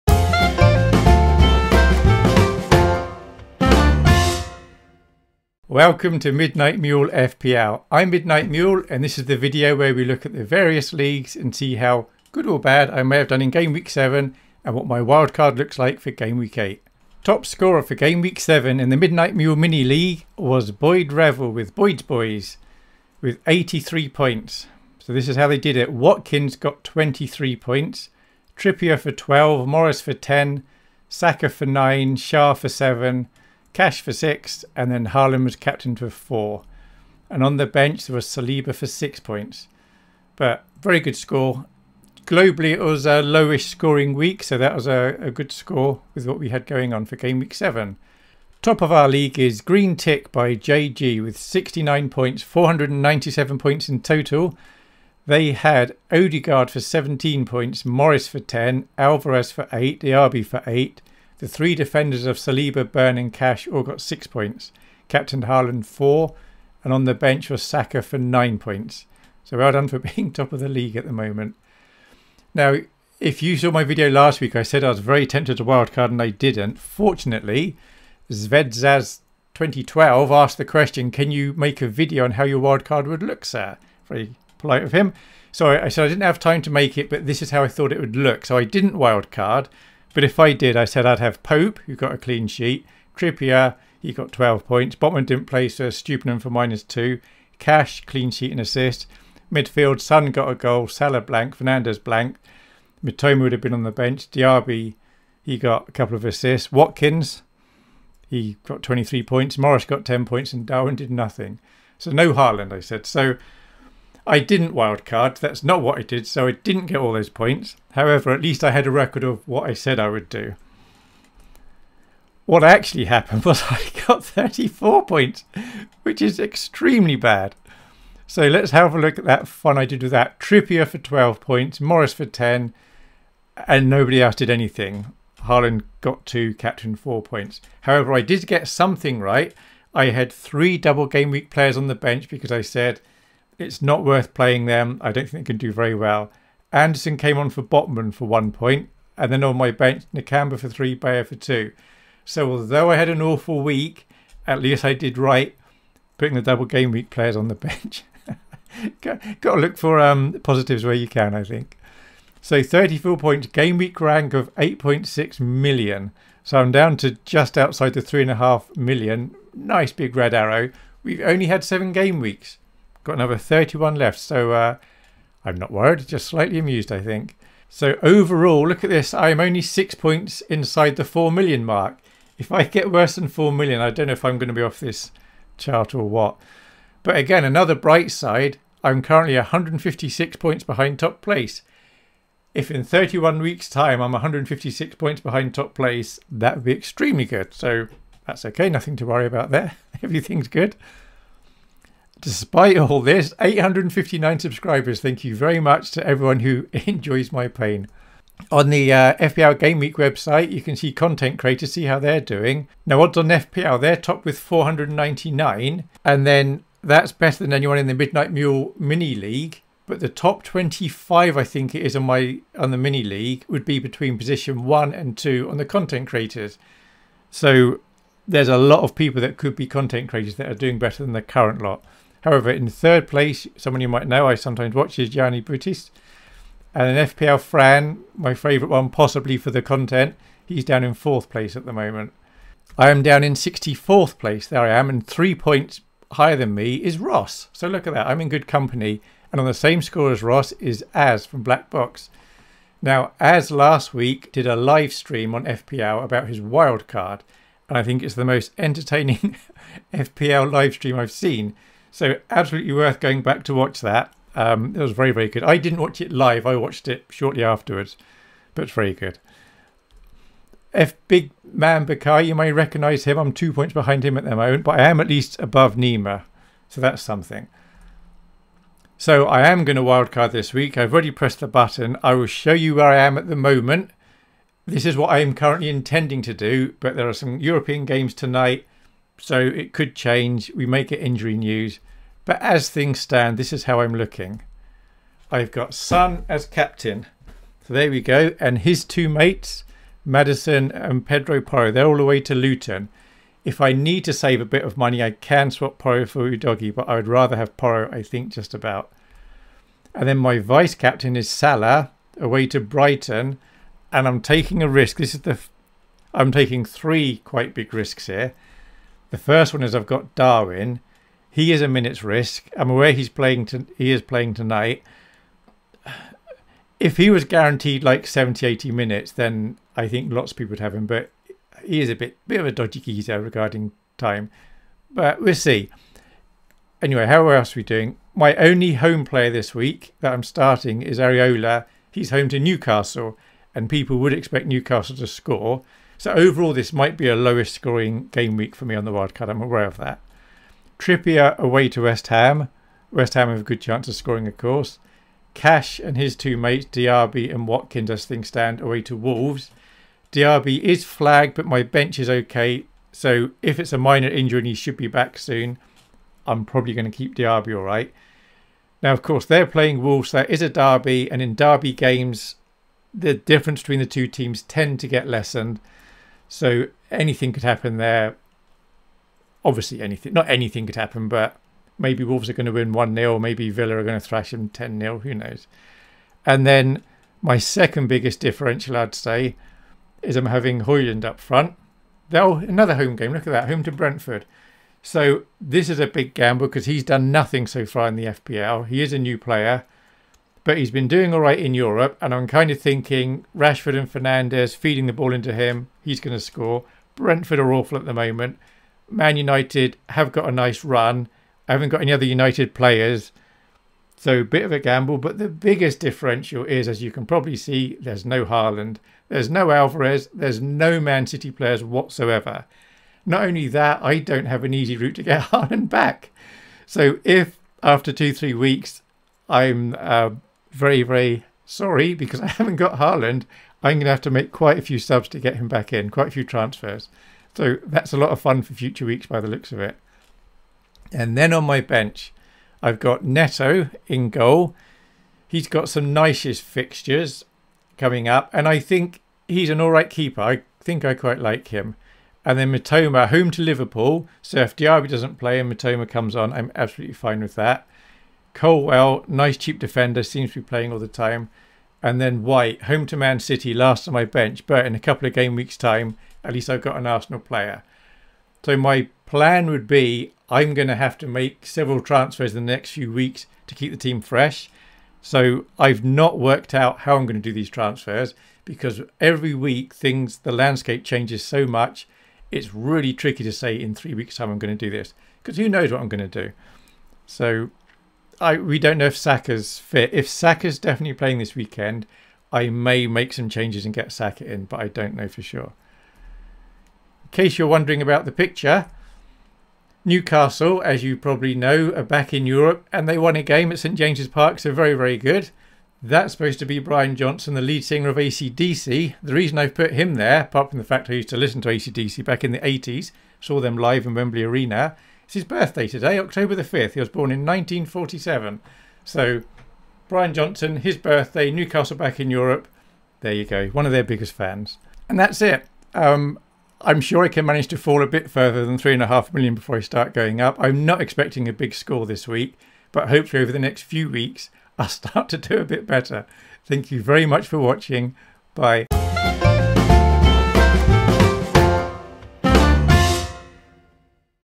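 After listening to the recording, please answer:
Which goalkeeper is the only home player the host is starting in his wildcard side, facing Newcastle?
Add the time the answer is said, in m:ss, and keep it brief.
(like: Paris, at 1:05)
Areola, at 5:40.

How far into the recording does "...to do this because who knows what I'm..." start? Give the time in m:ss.
8:04.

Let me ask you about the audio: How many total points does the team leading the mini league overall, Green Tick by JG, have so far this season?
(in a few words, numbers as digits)
497.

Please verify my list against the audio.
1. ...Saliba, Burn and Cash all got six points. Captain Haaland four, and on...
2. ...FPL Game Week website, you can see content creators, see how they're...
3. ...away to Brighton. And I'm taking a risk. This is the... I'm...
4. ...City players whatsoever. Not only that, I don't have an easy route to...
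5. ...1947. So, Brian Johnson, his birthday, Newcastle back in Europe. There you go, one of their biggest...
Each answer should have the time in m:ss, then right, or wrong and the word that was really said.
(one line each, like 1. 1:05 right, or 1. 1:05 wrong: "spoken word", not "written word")
1. 1:02 right
2. 3:29 right
3. 5:12 right
4. 7:01 right
5. 8:37 right.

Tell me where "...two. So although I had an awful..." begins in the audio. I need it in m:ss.
2:31.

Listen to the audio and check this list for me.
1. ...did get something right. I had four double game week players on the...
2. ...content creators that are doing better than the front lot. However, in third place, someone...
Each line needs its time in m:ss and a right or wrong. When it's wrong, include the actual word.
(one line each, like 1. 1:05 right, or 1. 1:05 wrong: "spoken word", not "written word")
1. 2:18 wrong: "three", not "four"
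2. 3:49 wrong: "current", not "front".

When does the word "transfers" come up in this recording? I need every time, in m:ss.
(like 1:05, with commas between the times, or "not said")
7:16, 7:51, 7:57.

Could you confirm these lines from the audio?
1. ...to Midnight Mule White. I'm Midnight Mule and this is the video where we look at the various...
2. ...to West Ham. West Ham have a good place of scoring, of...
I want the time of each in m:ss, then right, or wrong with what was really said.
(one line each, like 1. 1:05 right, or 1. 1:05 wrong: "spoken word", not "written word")
1. 0:06 wrong: "FPL", not "White"
2. 5:51 wrong: "chance", not "place".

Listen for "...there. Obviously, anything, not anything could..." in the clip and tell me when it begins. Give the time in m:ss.
6:17.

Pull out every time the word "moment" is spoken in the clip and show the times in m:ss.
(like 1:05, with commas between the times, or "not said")
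1:11, 4:01, 4:34, 4:43, 6:47.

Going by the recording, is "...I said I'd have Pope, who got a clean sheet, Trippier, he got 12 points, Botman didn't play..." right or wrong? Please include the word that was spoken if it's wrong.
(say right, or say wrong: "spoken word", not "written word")
right.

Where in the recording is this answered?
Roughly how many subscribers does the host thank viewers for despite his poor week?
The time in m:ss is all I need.
3:23.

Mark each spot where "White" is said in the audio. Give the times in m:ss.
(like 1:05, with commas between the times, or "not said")
7:42.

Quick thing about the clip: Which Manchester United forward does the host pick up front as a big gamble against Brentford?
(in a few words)
Hojlund.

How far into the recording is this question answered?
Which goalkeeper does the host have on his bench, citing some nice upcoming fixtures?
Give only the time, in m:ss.
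7:23.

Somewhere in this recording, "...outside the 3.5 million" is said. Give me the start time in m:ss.
2:47.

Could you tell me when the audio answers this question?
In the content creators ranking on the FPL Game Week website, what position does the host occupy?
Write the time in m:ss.
4:03.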